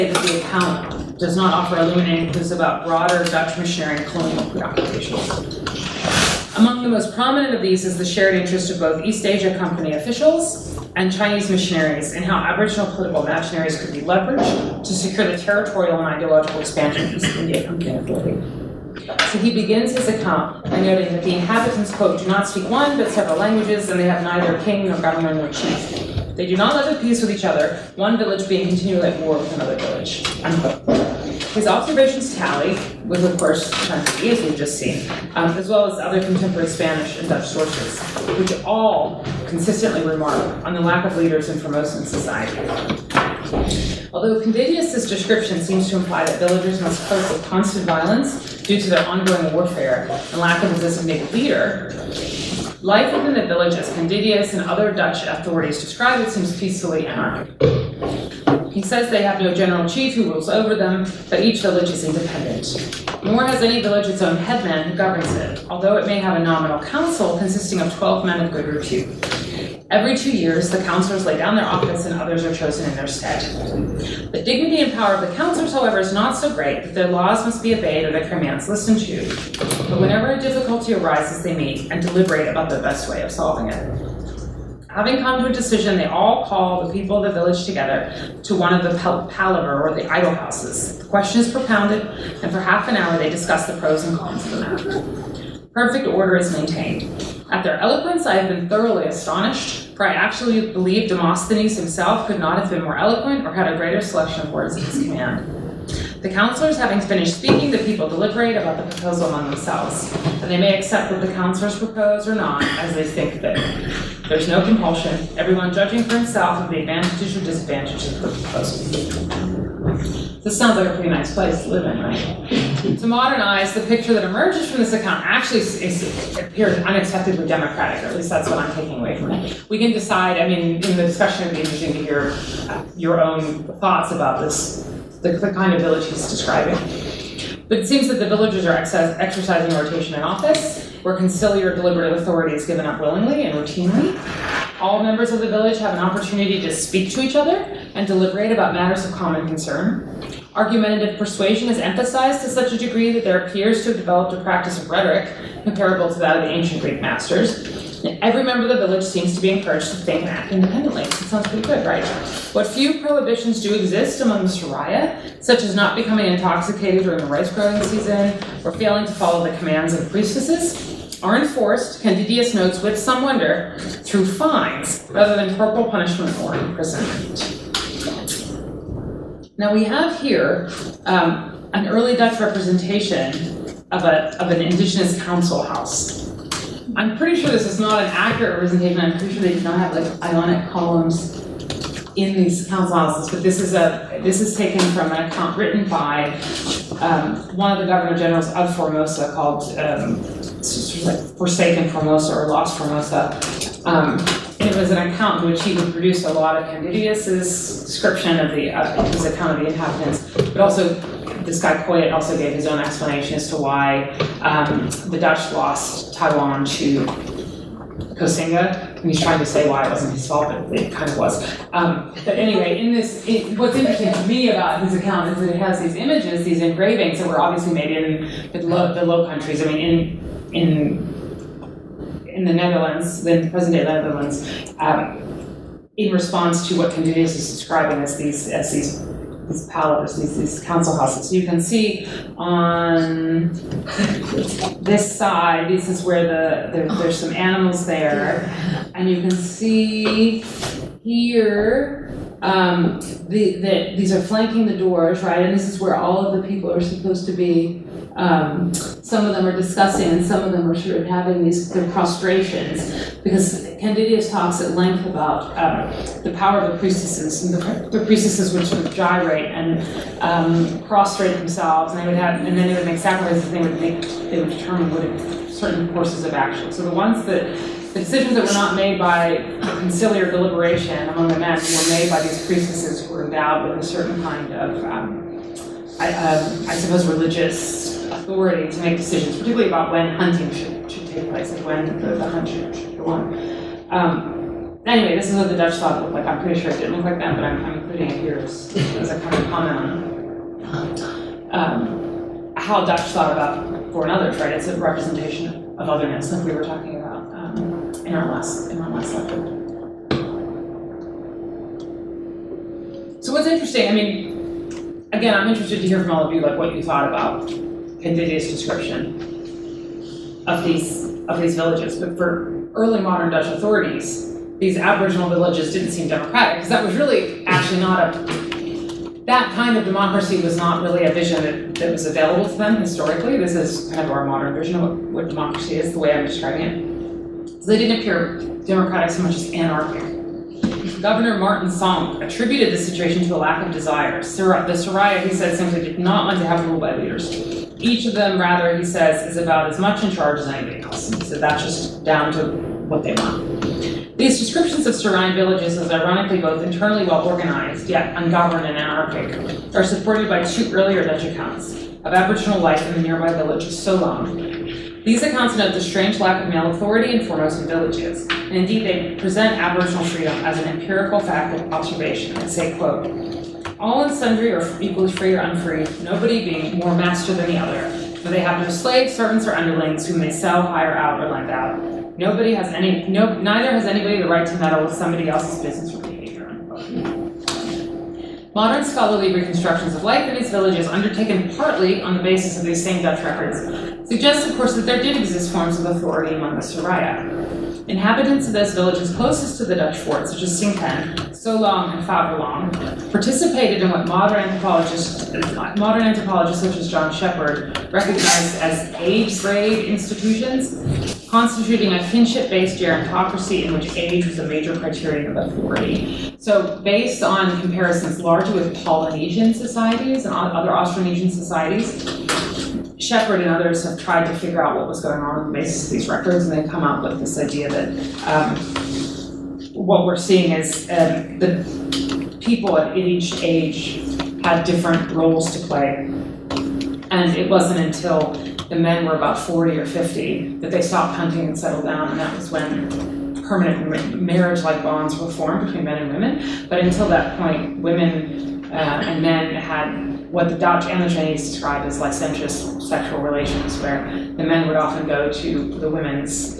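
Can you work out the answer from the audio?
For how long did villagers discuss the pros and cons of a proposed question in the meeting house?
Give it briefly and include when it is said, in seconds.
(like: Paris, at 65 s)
Half an hour, at 92 s.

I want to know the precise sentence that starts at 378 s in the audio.
For they have no slaves, servants, or underlings whom they sell, hire out, or lend out.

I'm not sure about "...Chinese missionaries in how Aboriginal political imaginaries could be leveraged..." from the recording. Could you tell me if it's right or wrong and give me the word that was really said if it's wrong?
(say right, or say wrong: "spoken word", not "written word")
right.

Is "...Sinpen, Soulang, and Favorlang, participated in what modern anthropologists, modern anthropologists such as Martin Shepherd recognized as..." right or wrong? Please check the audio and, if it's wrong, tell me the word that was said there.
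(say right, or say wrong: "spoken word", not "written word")
wrong: "John", not "Martin".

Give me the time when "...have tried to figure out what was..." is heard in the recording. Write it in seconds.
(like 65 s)
423 s.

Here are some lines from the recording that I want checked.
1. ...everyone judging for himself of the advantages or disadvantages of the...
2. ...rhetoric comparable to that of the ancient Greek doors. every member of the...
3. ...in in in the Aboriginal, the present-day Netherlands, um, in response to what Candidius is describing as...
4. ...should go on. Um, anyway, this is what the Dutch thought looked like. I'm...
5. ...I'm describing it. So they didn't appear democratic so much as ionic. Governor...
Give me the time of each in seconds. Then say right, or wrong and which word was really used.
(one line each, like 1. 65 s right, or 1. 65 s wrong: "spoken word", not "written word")
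1. 115 s right
2. 154 s wrong: "masters", not "doors"
3. 230 s wrong: "Netherlands", not "Aboriginal"
4. 292 s right
5. 336 s wrong: "anarchic", not "ionic".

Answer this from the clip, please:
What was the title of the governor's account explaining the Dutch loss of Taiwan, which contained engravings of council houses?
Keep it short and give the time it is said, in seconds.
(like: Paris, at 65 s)
Forsaken Formosa, at 201 s.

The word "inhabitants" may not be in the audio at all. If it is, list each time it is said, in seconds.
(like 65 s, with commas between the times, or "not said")
21 s, 209 s, 397 s.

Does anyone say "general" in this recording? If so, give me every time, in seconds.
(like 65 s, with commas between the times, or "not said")
59 s, 198 s.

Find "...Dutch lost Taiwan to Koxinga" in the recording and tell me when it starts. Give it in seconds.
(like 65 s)
215 s.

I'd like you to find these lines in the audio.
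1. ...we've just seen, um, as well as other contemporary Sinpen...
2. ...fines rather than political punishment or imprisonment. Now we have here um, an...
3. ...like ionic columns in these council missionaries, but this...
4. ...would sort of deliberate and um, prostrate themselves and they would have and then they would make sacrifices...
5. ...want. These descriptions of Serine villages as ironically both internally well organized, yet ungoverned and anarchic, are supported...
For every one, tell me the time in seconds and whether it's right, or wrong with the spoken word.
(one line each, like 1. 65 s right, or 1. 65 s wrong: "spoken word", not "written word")
1. 34 s wrong: "Spanish", not "Sinpen"
2. 174 s wrong: "corporal", not "political"
3. 189 s wrong: "houses", not "missionaries"
4. 268 s wrong: "gyrate", not "deliberate"
5. 353 s right.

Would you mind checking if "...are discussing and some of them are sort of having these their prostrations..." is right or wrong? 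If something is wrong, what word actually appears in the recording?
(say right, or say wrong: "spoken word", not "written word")
right.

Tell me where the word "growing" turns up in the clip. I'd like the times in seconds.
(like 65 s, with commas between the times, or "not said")
167 s.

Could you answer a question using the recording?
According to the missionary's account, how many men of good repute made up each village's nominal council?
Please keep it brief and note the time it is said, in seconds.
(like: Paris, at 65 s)
12, at 67 s.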